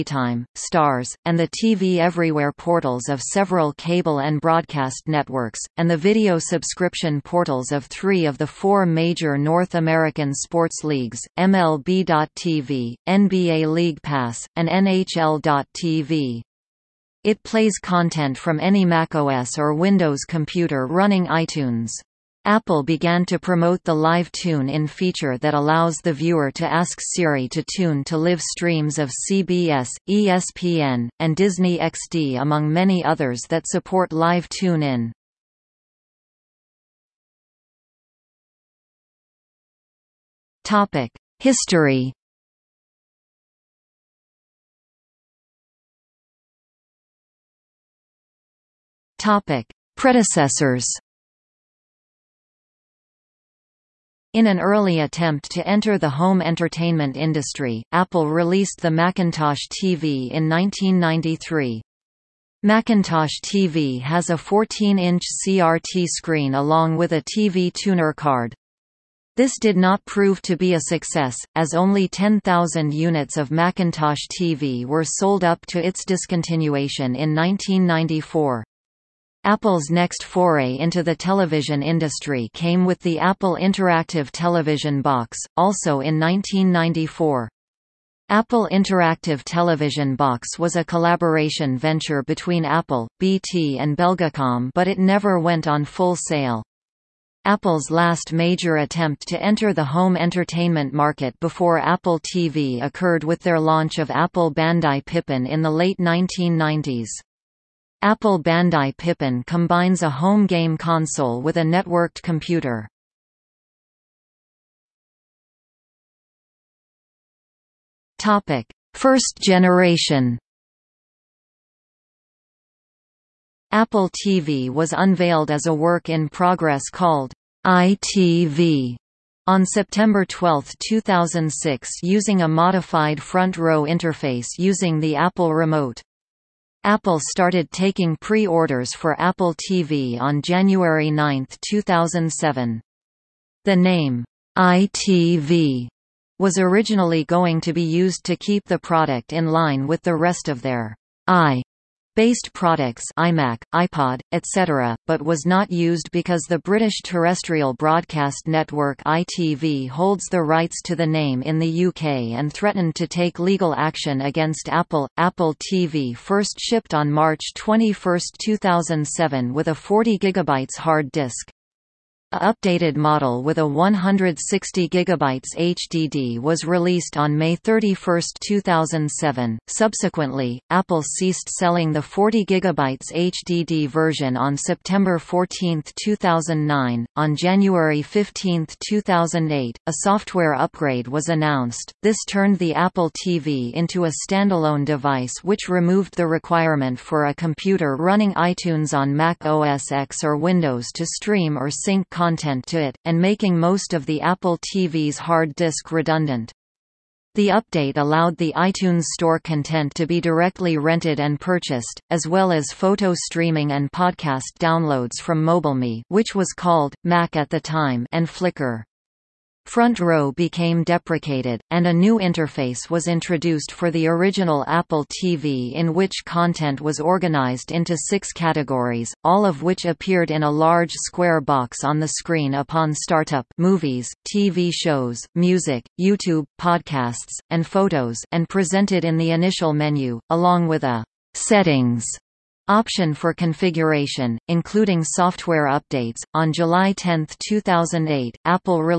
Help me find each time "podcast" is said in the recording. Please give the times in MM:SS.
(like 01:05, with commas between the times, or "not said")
03:33, 03:56.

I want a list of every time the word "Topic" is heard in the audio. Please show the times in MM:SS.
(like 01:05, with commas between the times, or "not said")
00:40, 00:49.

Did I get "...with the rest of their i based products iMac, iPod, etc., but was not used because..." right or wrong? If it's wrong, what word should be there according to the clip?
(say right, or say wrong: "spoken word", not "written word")
right.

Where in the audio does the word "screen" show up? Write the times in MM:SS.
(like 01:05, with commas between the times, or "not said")
01:06, 03:52.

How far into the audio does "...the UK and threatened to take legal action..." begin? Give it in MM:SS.
02:41.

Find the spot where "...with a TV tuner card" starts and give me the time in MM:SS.
01:06.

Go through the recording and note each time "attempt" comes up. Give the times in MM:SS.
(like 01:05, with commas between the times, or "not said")
00:55, 01:38.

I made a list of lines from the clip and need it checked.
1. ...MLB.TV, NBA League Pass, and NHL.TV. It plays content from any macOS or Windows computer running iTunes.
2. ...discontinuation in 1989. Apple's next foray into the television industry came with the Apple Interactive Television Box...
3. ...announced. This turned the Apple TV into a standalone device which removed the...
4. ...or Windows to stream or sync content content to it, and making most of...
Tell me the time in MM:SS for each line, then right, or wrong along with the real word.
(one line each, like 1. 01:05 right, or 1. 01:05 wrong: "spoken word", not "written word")
1. 00:11 right
2. 01:16 wrong: "1994", not "1989"
3. 03:11 right
4. 03:20 right.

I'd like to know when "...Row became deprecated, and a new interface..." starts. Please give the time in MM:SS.
03:39.